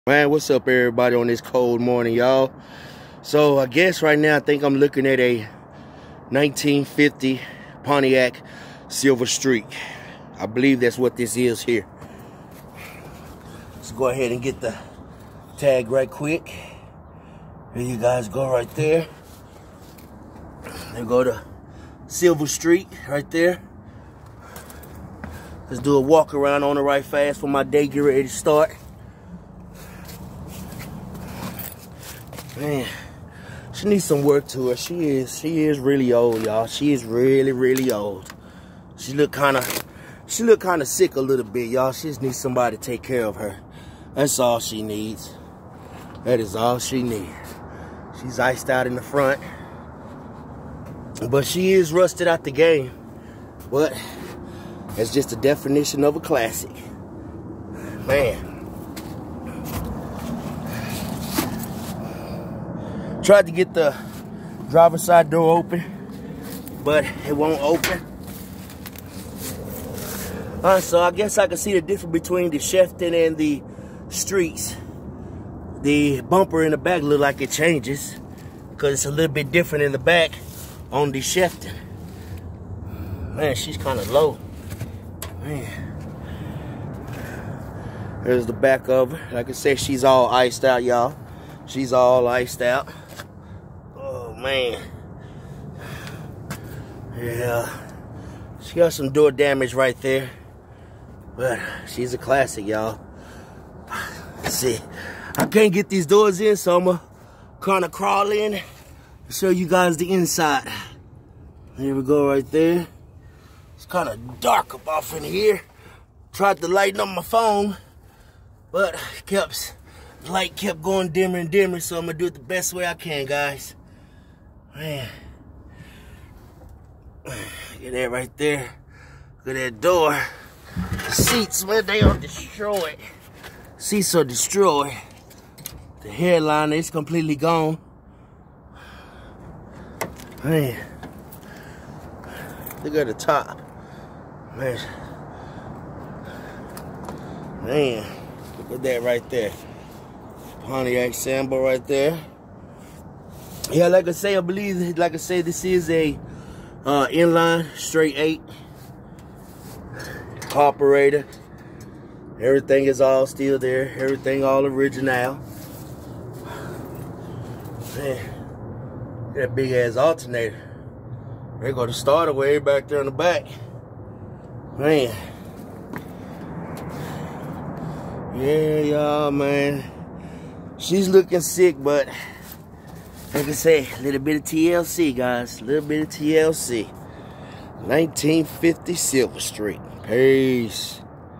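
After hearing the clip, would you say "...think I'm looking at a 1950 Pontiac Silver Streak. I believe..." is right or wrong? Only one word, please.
right.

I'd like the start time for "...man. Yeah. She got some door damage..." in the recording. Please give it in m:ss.
1:34.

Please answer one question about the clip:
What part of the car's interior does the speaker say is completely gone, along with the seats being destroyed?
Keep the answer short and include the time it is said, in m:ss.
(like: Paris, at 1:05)
The headliner, at 2:16.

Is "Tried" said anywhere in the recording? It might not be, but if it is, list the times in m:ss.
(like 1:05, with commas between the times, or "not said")
1:03, 1:56.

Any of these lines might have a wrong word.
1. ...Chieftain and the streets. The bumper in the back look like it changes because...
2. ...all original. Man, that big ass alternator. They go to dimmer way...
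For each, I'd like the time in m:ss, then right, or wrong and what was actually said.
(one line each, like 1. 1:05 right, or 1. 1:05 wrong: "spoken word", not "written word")
1. 1:12 right
2. 2:44 wrong: "starter", not "dimmer".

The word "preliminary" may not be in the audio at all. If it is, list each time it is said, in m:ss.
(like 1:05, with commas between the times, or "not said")
not said.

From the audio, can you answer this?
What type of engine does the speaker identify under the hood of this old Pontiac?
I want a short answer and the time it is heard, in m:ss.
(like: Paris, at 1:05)
Inline straight eight, at 2:37.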